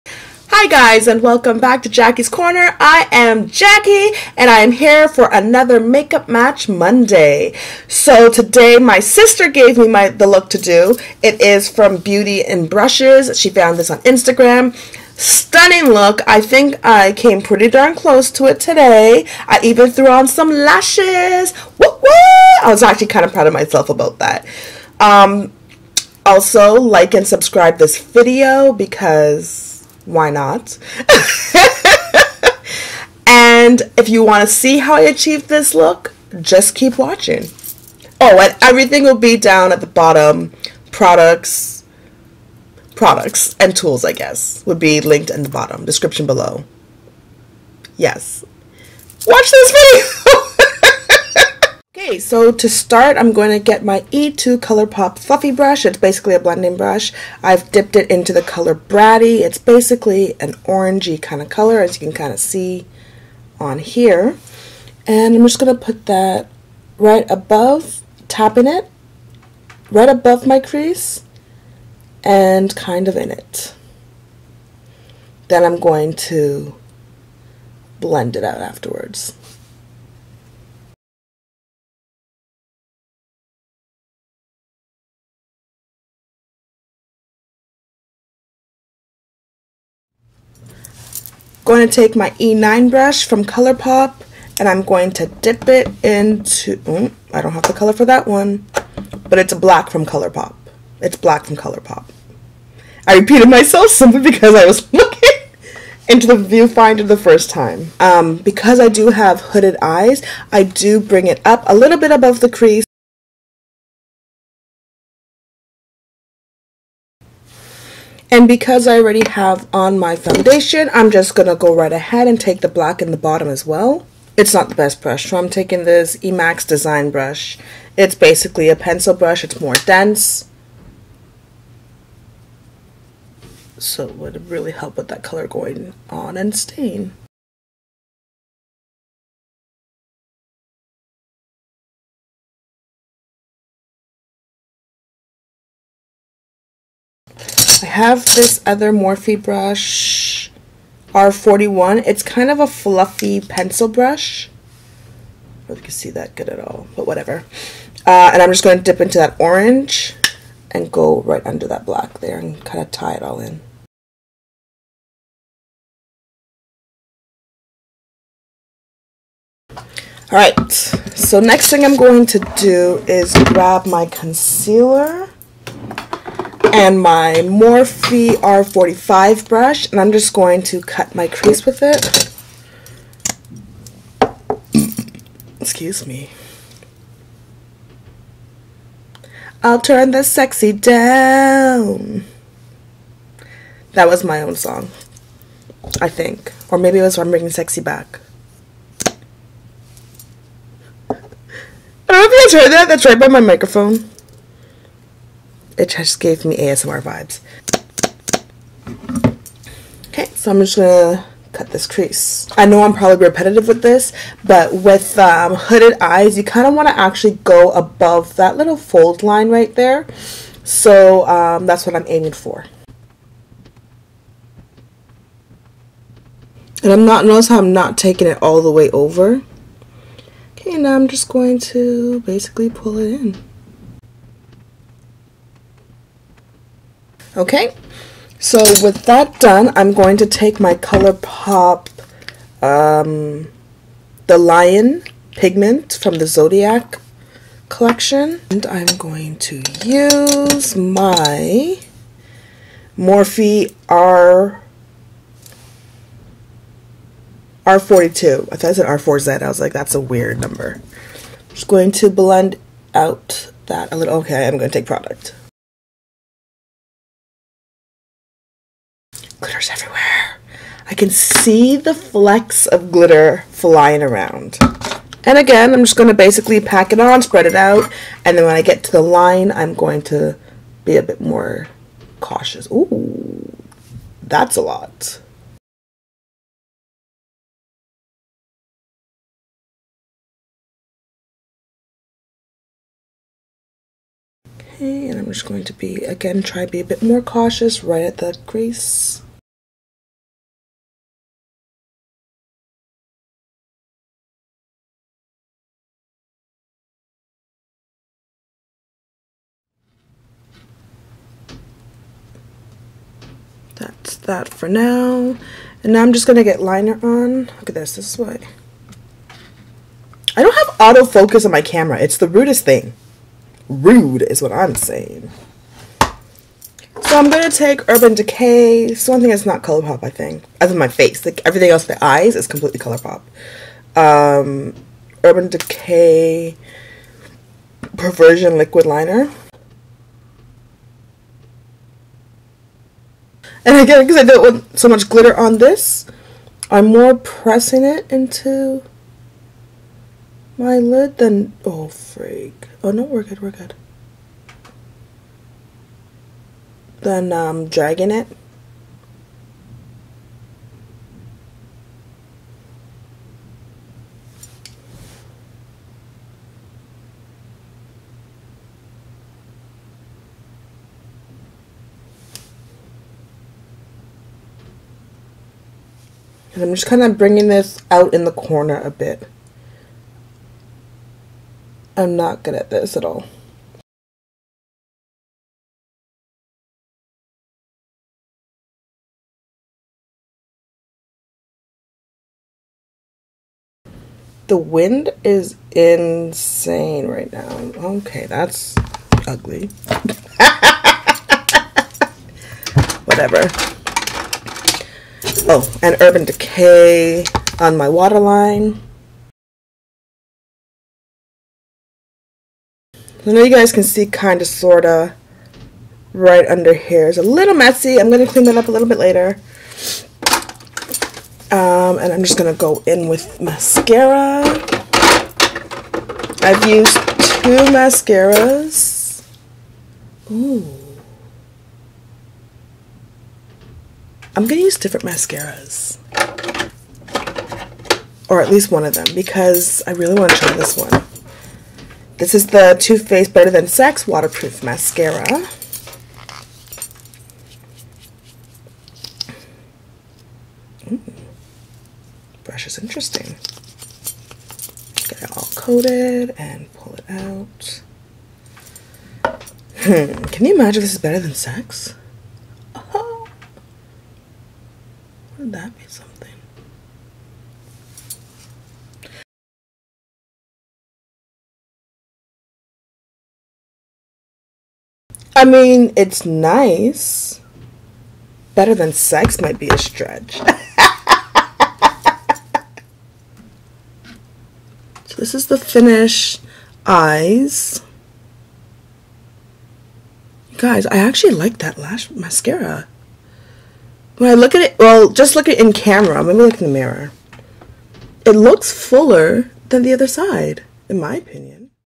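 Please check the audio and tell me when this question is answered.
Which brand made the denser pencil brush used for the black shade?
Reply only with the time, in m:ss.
2:06.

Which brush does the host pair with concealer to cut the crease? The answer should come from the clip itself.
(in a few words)
Morphe R45.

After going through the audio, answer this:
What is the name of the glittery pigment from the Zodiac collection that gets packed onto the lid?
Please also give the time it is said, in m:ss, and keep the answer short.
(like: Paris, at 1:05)
The Lion, at 4:04.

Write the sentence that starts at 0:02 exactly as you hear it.
I am Jackie, and I am here for another Makeup Match Monday.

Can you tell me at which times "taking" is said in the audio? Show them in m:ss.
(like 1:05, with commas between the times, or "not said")
2:05, 3:47.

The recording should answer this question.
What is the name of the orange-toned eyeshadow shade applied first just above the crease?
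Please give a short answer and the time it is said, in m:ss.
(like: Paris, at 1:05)
Bratty, at 0:58.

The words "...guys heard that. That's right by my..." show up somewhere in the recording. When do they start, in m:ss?
3:22.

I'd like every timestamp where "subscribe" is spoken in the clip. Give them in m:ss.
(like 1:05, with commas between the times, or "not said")
0:27.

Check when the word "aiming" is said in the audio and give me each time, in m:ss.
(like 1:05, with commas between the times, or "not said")
3:42.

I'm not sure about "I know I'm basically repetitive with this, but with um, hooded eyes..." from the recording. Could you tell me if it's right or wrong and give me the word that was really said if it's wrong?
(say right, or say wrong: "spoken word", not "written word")
wrong: "probably", not "basically".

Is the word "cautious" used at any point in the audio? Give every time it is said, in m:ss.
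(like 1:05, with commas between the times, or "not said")
4:42, 4:57.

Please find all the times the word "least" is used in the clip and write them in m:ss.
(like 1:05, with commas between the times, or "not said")
7:18.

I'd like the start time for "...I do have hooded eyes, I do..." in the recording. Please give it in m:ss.
1:48.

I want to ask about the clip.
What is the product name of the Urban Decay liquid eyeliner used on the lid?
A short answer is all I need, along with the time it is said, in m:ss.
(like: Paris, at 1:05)
Perversion, at 5:37.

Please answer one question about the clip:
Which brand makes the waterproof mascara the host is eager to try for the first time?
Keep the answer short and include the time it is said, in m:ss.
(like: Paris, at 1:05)
Too Faced, at 7:22.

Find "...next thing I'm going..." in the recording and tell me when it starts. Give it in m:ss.
2:51.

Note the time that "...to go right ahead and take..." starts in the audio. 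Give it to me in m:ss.
2:01.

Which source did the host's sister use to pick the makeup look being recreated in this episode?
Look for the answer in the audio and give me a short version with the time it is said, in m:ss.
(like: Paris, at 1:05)
Beauty and Brushes, at 0:11.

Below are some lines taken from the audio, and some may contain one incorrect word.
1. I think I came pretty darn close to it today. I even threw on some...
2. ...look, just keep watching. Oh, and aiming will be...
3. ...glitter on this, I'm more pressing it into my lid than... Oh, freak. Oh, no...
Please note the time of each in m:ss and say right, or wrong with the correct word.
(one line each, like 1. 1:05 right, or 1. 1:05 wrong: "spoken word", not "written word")
1. 0:16 right
2. 0:35 wrong: "everything", not "aiming"
3. 5:45 right.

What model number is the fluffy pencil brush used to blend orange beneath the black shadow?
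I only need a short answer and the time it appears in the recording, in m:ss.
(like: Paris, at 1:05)
R41, at 2:31.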